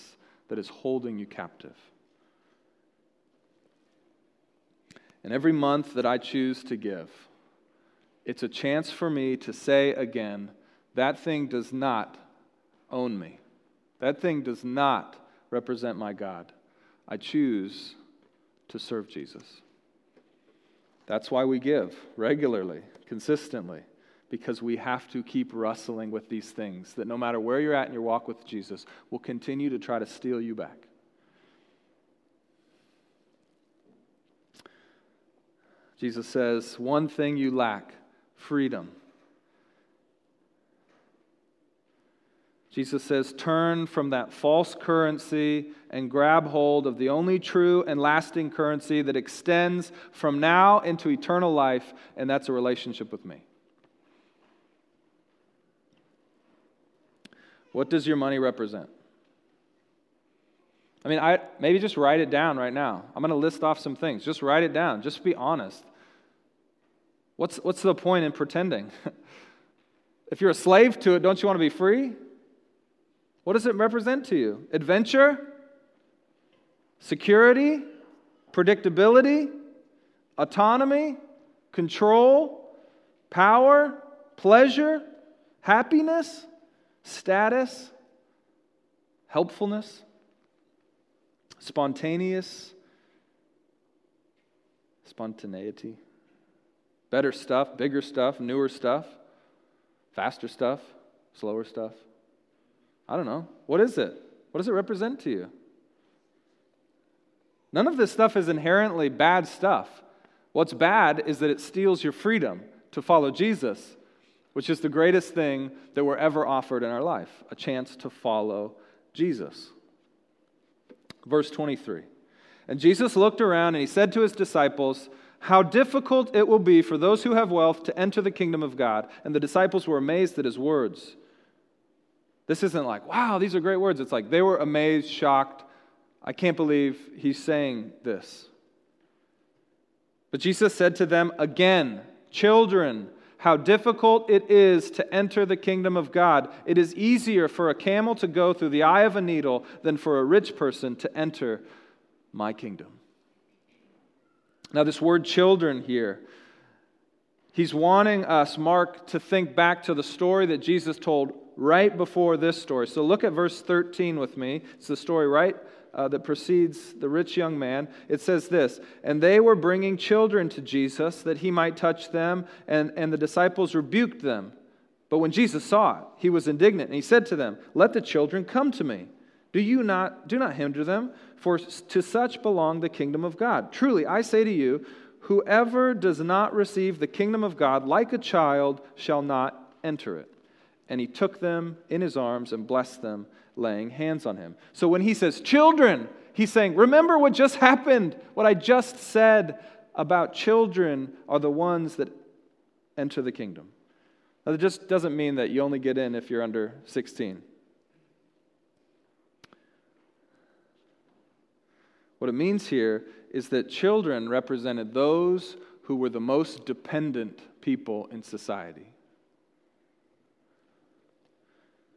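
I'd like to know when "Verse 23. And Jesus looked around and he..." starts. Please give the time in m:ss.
2:01.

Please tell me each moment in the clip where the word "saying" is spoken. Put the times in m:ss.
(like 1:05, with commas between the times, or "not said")
2:17, 3:16.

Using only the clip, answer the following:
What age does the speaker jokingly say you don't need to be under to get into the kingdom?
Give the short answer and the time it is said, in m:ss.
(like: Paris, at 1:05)
16, at 3:26.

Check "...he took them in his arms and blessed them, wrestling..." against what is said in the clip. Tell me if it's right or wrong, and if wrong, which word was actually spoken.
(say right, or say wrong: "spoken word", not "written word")
wrong: "laying", not "wrestling".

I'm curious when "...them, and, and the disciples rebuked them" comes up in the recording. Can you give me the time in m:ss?
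2:52.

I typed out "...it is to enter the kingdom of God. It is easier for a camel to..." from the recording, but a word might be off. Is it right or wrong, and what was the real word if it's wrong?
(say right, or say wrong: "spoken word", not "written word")
right.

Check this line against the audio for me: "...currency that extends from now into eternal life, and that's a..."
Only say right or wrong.
right.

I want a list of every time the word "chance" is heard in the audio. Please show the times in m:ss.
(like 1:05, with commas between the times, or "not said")
0:08, 1:57.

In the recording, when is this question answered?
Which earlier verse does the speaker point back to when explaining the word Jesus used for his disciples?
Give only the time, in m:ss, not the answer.
2:43.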